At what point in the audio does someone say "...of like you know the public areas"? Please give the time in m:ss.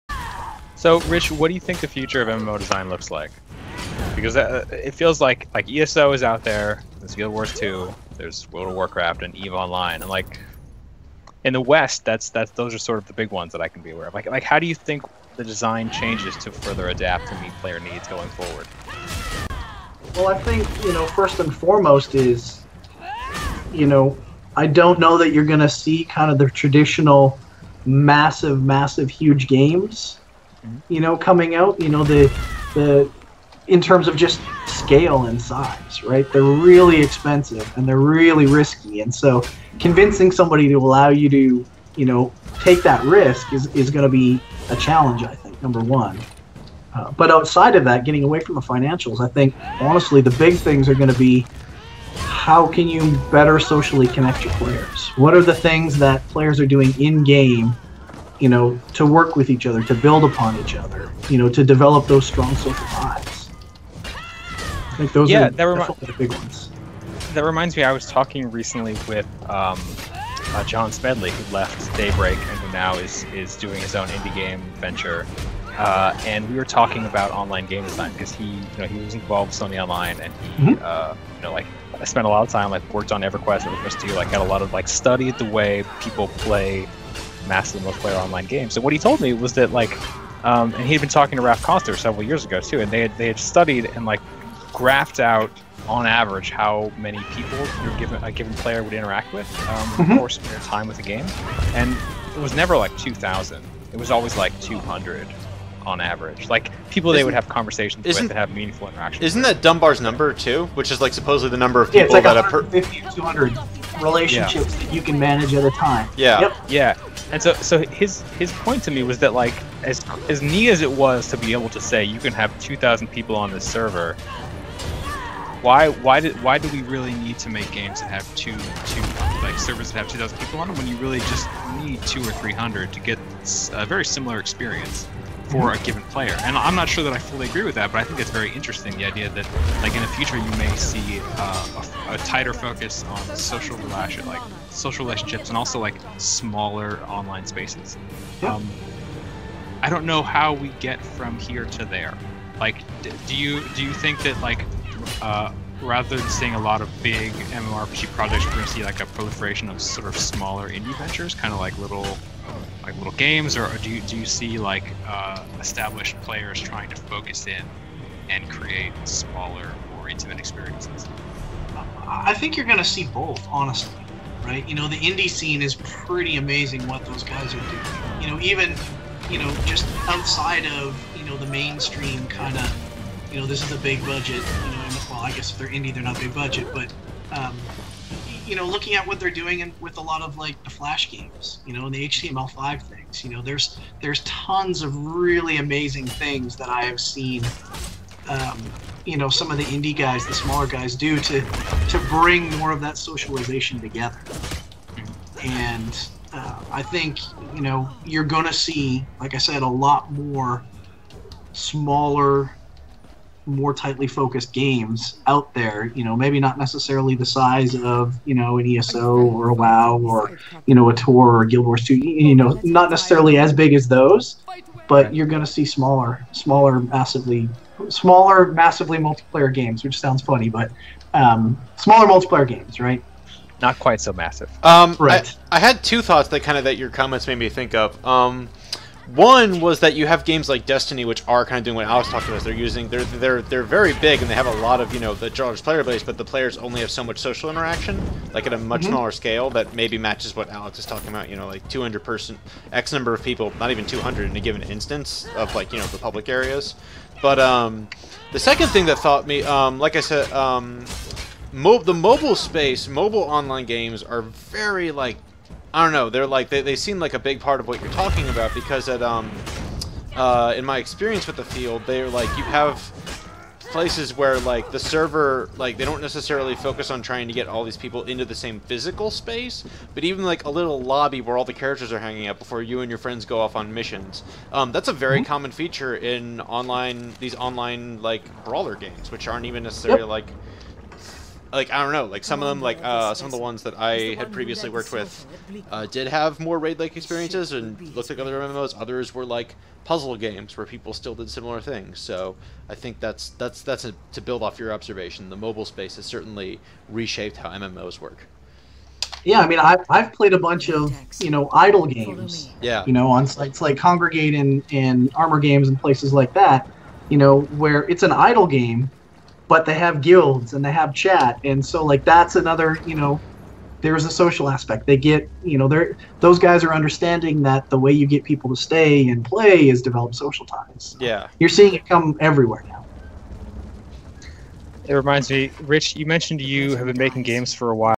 4:15.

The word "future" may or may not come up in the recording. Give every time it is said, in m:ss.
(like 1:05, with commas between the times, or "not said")
0:01, 2:20.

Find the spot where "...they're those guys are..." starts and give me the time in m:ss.
5:25.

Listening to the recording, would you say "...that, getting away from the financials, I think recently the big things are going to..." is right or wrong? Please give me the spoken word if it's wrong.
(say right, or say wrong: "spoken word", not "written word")
wrong: "honestly", not "recently".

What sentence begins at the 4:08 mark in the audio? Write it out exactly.
smaller scale that maybe matches what Alex is talking about.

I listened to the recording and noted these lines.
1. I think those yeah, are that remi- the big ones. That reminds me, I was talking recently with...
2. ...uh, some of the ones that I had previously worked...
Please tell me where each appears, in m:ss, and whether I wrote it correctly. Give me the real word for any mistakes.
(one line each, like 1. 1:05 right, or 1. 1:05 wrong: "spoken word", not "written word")
1. 1:04 right
2. 4:52 right.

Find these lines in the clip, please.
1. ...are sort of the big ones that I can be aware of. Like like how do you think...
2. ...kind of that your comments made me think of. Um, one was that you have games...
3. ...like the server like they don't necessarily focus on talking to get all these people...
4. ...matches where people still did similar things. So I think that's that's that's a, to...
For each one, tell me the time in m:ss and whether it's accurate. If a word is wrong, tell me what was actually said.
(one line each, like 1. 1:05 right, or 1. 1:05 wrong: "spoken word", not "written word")
1. 0:12 right
2. 3:56 right
3. 4:34 wrong: "trying", not "talking"
4. 5:00 wrong: "games", not "matches".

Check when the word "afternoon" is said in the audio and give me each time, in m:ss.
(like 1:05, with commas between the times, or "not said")
not said.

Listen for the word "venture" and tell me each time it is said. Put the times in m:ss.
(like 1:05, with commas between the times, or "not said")
1:14, 2:40.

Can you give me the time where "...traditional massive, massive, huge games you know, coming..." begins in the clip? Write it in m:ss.
0:26.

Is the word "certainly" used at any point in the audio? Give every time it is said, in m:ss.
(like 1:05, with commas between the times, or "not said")
5:06.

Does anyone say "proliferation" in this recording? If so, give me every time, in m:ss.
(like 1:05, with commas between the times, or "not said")
2:39.